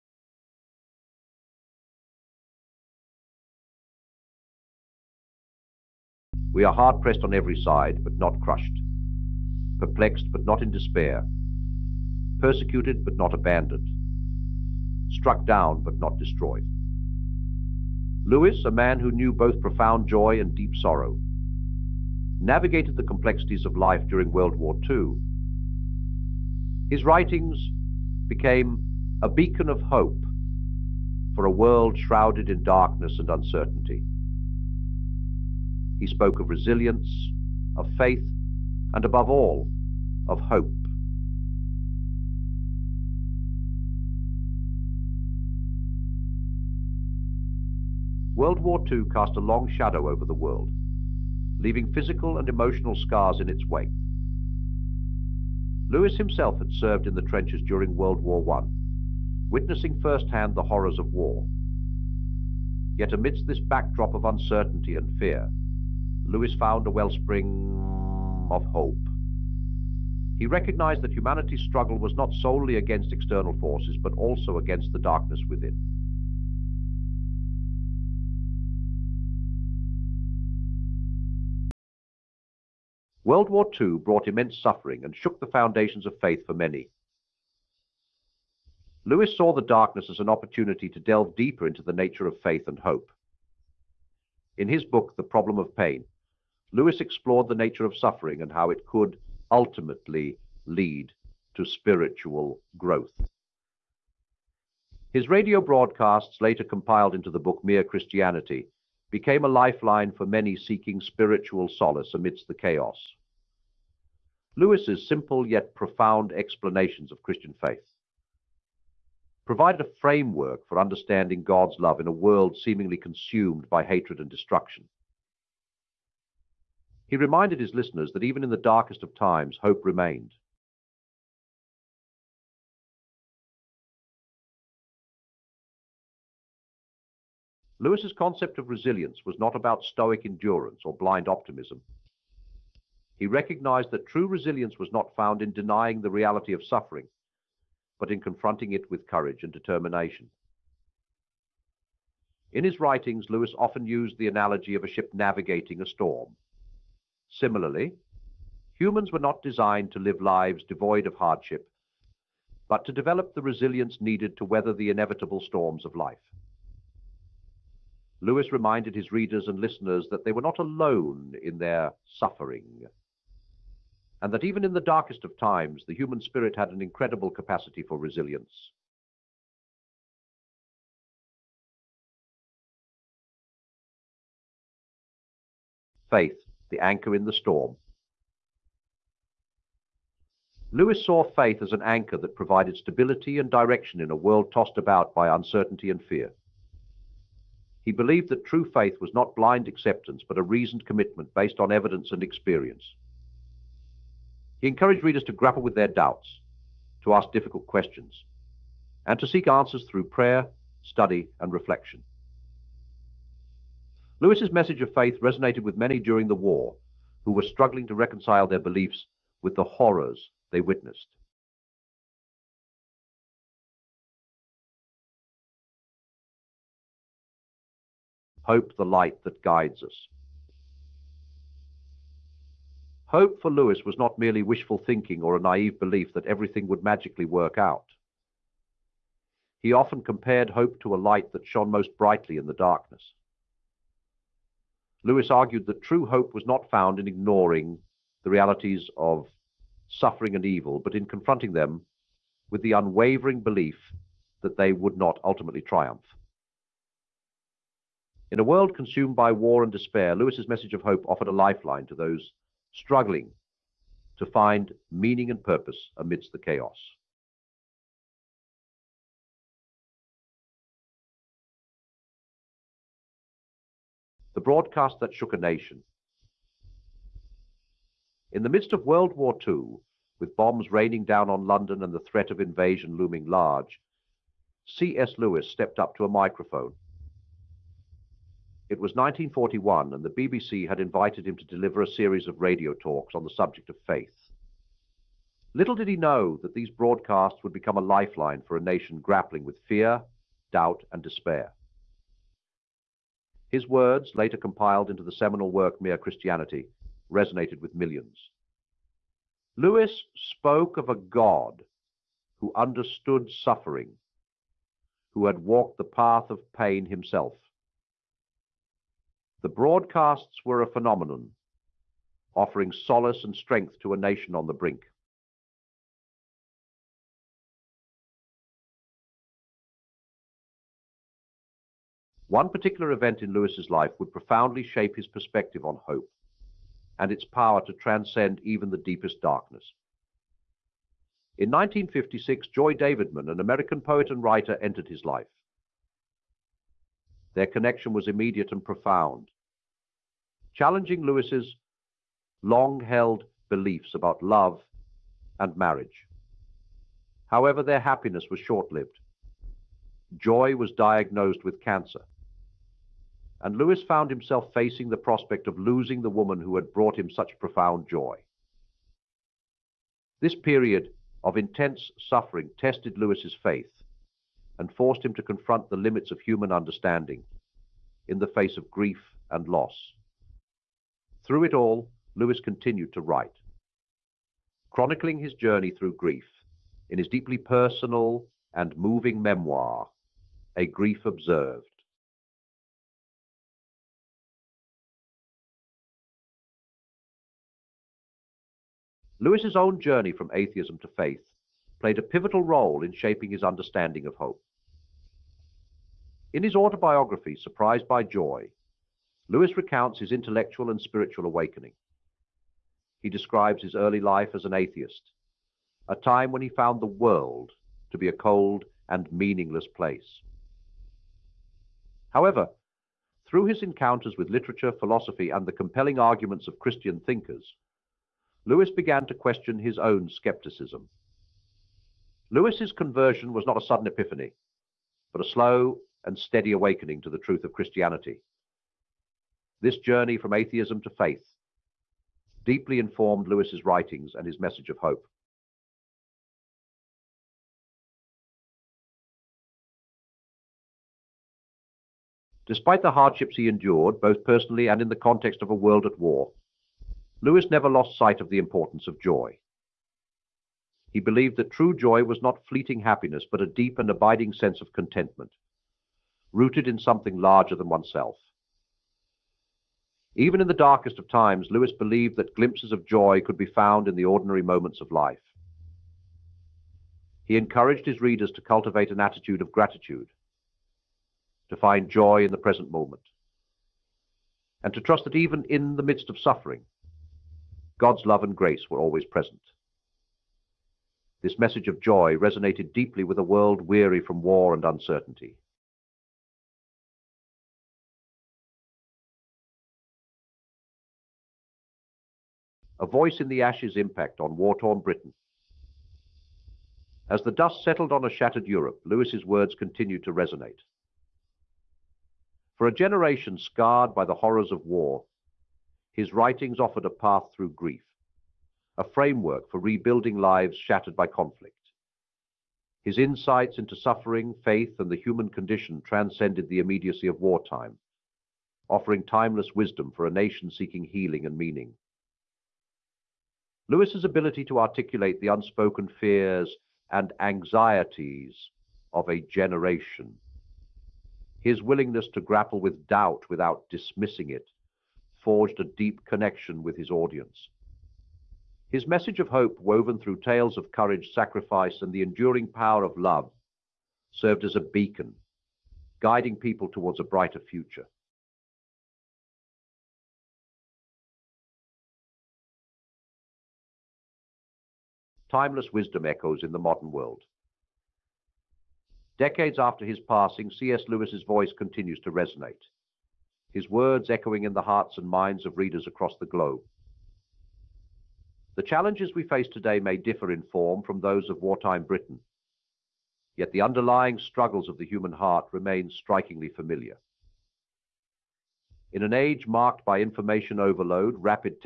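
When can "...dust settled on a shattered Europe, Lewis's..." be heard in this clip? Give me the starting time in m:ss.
8:27.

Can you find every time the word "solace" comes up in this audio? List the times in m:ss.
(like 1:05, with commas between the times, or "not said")
1:51, 5:22.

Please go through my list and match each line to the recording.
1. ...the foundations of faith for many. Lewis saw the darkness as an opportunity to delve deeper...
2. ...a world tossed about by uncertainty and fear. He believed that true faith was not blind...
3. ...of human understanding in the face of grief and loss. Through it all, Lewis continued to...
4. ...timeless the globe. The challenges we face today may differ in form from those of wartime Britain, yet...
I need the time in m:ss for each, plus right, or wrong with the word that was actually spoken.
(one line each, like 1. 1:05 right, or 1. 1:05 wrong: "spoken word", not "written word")
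1. 1:25 right
2. 3:14 right
3. 6:16 right
4. 9:35 wrong: "across", not "timeless".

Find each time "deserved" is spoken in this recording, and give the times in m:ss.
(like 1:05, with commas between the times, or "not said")
not said.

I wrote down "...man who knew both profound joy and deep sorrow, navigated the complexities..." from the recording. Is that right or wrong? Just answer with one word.
right.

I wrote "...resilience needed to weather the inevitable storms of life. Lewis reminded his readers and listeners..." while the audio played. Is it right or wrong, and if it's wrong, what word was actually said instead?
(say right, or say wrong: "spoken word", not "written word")
right.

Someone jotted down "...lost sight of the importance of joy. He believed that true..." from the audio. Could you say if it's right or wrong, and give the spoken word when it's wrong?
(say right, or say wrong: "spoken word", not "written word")
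right.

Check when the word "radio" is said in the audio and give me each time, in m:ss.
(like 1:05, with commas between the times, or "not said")
1:45, 4:52.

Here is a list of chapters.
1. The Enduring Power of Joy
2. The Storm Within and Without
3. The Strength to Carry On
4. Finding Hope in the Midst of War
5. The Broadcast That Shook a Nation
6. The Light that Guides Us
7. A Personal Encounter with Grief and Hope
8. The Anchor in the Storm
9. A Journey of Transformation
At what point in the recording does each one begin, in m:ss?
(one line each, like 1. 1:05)
1. 7:24
2. 0:40
3. 2:10
4. 1:15
5. 4:26
6. 3:41
7. 5:24
8. 2:58
9. 6:31.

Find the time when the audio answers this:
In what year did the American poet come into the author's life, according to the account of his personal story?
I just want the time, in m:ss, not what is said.
5:41.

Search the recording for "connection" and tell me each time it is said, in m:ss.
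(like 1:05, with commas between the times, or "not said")
5:47, 9:06.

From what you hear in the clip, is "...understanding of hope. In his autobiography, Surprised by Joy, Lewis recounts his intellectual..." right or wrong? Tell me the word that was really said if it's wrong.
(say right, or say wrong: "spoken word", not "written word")
right.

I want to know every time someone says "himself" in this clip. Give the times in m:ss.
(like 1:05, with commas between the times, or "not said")
0:56, 5:16, 6:04.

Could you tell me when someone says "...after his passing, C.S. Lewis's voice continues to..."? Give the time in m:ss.
9:29.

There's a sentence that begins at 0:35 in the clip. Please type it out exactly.
He spoke of resilience, of faith, and above all, of hope.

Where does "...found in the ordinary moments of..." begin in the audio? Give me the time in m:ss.
7:53.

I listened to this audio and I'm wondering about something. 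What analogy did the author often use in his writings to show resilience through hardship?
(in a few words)
A ship navigating a storm.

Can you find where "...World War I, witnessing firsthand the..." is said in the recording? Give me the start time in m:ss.
0:57.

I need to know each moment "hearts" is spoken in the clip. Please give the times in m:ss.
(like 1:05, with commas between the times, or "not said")
9:34, 9:45.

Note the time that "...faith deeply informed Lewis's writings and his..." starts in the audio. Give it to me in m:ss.
7:20.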